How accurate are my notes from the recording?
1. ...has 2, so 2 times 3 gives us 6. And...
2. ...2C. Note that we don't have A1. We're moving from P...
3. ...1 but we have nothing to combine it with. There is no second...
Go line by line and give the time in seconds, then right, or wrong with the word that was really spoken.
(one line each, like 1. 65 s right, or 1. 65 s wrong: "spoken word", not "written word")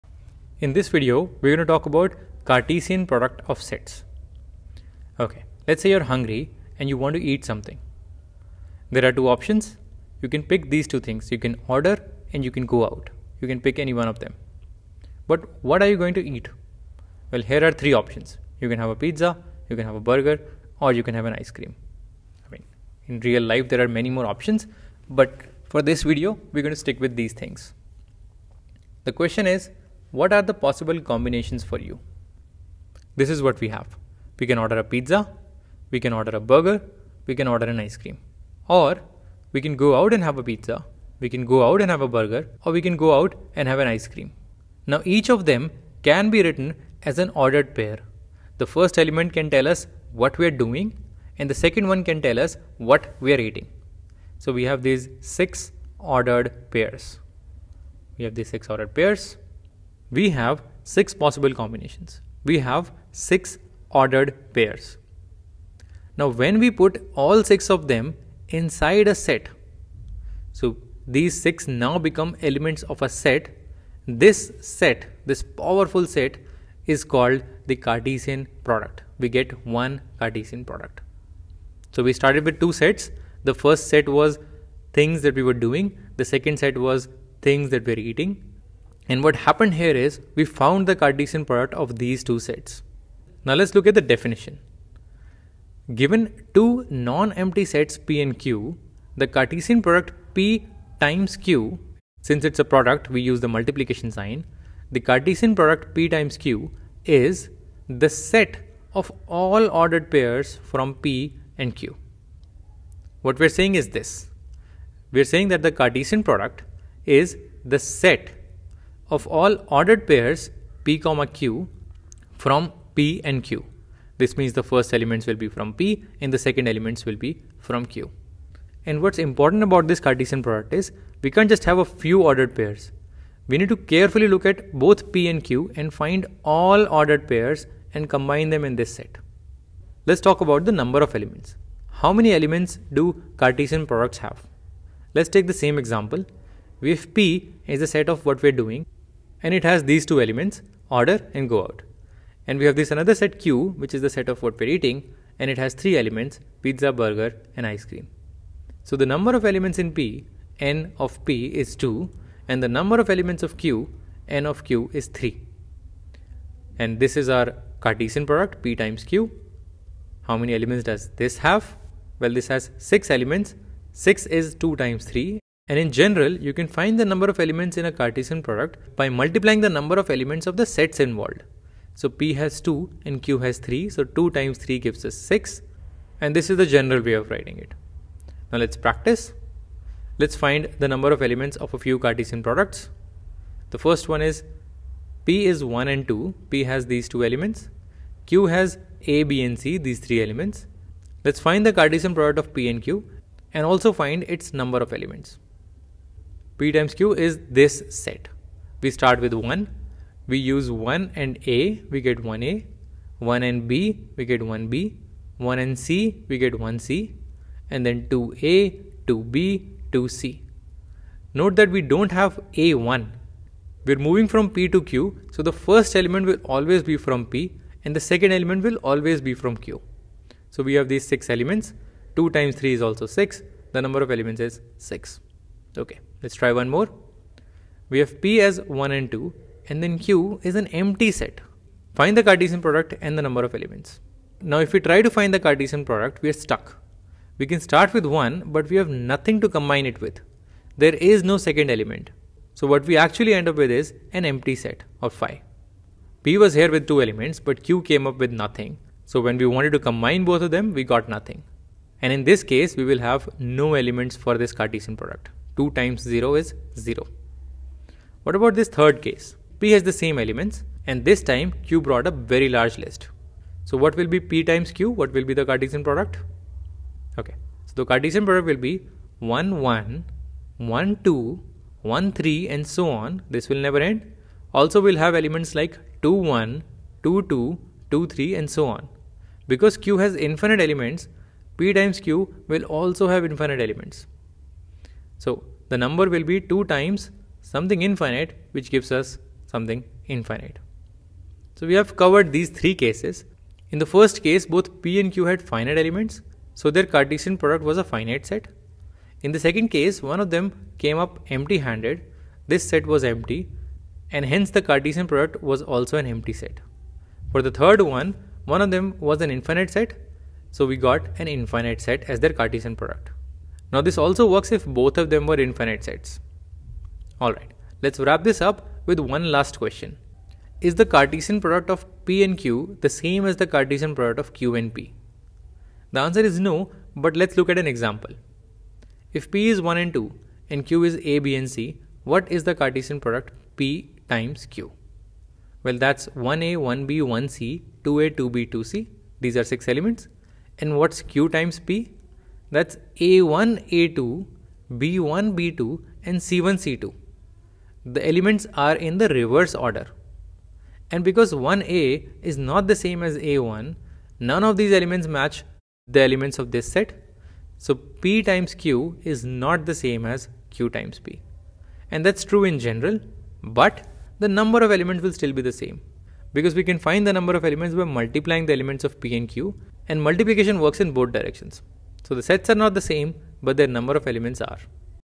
1. 183 s wrong: "3", not "2"
2. 219 s right
3. 248 s right.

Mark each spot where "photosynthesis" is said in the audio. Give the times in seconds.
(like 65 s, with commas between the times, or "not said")
not said.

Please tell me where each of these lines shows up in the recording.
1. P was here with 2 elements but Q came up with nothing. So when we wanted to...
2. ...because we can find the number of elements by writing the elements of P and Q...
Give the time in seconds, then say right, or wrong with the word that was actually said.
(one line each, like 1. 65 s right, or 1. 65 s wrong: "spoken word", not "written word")
1. 256 s right
2. 376 s wrong: "multiplying", not "writing".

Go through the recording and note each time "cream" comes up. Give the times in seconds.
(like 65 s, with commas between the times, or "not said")
21 s, 37 s, 44 s, 157 s.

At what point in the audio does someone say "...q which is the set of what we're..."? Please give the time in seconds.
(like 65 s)
153 s.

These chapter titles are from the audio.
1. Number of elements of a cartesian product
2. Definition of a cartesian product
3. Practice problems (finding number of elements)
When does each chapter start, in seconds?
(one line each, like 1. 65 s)
1. 142 s
2. 93 s
3. 191 s.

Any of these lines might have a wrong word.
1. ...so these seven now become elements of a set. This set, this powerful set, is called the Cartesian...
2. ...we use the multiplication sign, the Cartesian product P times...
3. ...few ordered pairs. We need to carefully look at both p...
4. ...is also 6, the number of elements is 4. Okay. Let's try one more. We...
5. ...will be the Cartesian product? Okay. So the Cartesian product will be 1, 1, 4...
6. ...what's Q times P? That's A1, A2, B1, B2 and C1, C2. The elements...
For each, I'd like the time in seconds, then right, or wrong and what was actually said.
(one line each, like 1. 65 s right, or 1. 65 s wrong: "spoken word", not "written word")
1. 70 s wrong: "six", not "seven"
2. 103 s right
3. 131 s right
4. 232 s wrong: "6", not "4"
5. 275 s wrong: "1", not "4"
6. 350 s right.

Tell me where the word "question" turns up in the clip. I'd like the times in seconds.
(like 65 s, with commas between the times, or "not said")
29 s, 329 s.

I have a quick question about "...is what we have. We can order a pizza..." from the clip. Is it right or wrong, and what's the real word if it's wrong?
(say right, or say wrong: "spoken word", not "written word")
right.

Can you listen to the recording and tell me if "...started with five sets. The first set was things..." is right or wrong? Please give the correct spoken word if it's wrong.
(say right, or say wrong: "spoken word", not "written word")
wrong: "two", not "five".